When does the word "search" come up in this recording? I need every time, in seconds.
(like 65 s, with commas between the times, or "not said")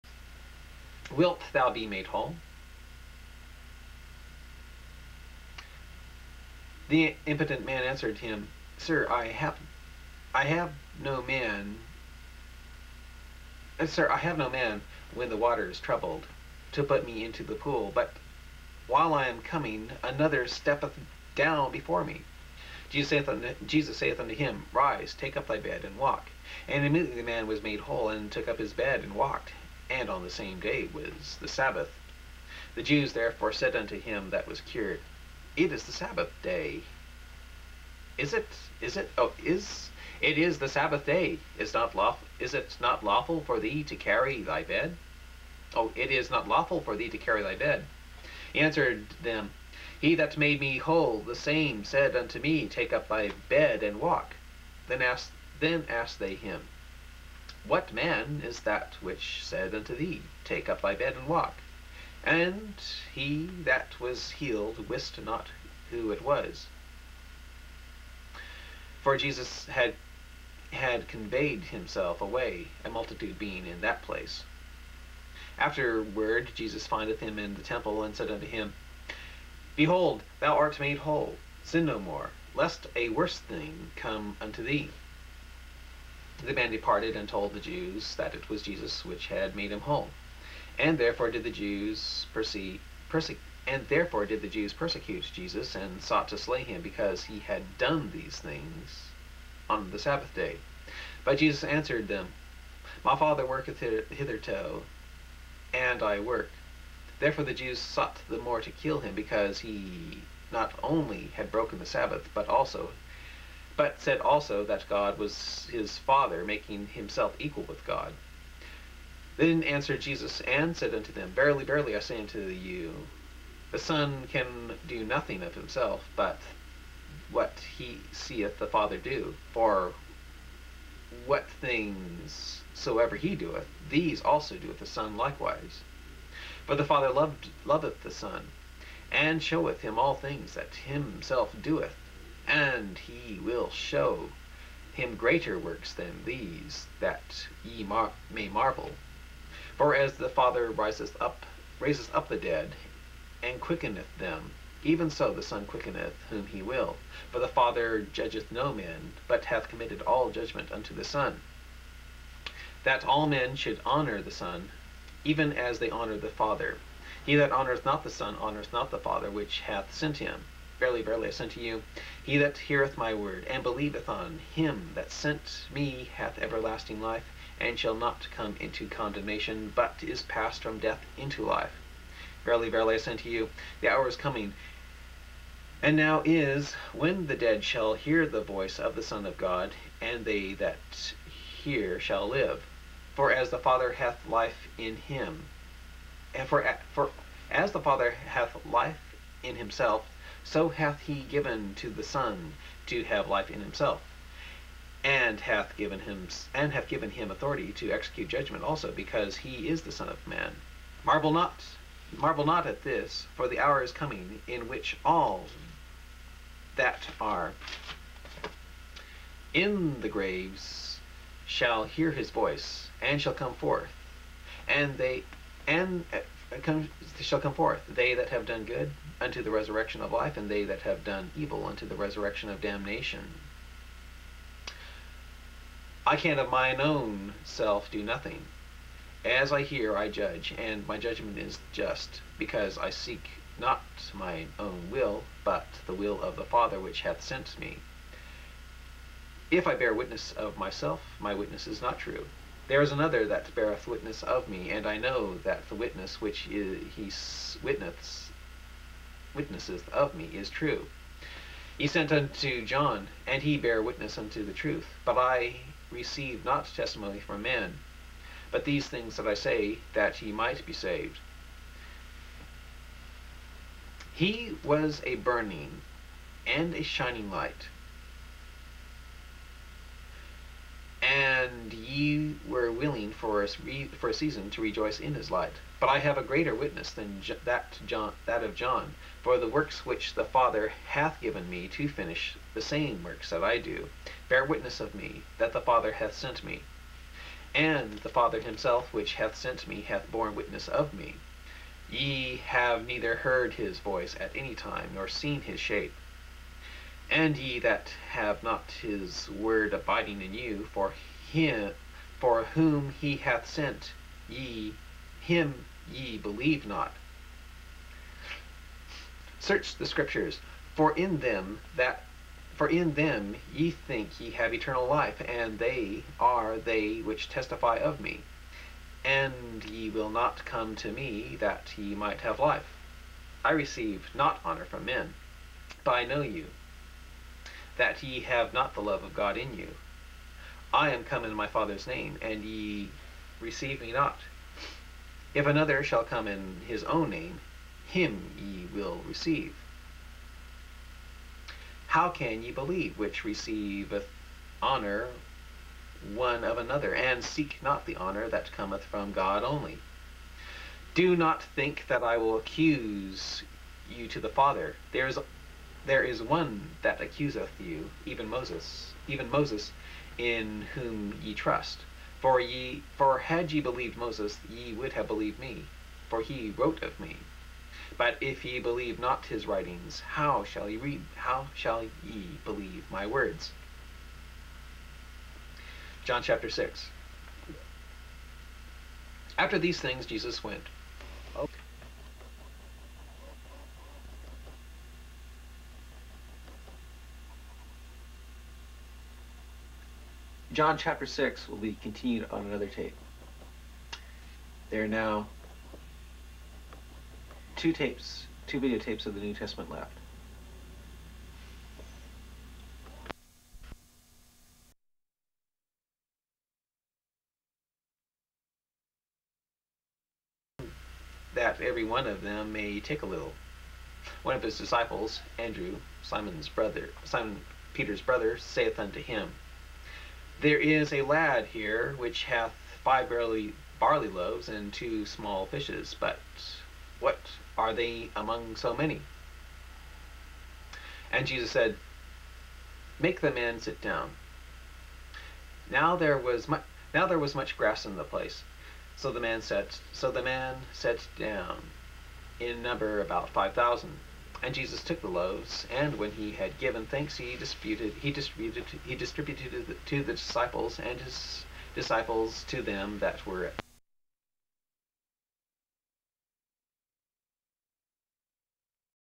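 319 s.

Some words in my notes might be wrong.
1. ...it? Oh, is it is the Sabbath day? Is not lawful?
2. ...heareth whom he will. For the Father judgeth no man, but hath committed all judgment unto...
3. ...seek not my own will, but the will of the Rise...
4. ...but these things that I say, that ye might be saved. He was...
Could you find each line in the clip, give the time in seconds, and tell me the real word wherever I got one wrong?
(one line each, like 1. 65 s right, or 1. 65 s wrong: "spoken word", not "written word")
1. 38 s right
2. 155 s wrong: "quickeneth", not "heareth"
3. 242 s wrong: "Father", not "Rise"
4. 268 s right.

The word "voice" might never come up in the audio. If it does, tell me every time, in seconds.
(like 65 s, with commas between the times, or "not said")
188 s, 222 s, 303 s.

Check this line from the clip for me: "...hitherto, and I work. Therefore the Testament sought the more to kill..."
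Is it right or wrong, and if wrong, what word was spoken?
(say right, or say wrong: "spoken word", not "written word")
wrong: "Jews", not "Testament".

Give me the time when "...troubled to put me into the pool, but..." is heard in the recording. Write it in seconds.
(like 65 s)
15 s.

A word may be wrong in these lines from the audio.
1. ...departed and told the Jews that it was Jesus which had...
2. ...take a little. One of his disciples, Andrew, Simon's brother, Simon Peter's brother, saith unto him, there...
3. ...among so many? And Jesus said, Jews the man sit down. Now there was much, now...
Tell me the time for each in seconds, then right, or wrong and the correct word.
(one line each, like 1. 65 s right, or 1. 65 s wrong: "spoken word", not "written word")
1. 86 s right
2. 422 s right
3. 438 s wrong: "Make", not "Jews".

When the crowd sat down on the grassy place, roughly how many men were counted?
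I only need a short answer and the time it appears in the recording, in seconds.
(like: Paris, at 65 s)
5000, at 453 s.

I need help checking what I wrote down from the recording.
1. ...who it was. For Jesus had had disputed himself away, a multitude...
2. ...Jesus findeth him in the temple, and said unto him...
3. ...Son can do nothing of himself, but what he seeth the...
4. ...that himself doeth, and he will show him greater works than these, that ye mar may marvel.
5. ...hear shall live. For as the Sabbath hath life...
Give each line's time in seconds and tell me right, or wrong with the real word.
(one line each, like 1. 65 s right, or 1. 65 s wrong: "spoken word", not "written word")
1. 65 s wrong: "conveyed", not "disputed"
2. 76 s right
3. 123 s right
4. 140 s right
5. 191 s wrong: "Father", not "Sabbath".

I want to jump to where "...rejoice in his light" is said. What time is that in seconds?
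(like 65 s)
284 s.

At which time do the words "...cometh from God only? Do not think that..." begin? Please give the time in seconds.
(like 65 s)
358 s.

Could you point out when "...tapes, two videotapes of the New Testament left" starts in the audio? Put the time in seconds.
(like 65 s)
407 s.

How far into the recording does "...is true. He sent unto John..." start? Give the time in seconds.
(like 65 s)
260 s.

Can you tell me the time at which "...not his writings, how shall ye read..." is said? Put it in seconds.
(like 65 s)
378 s.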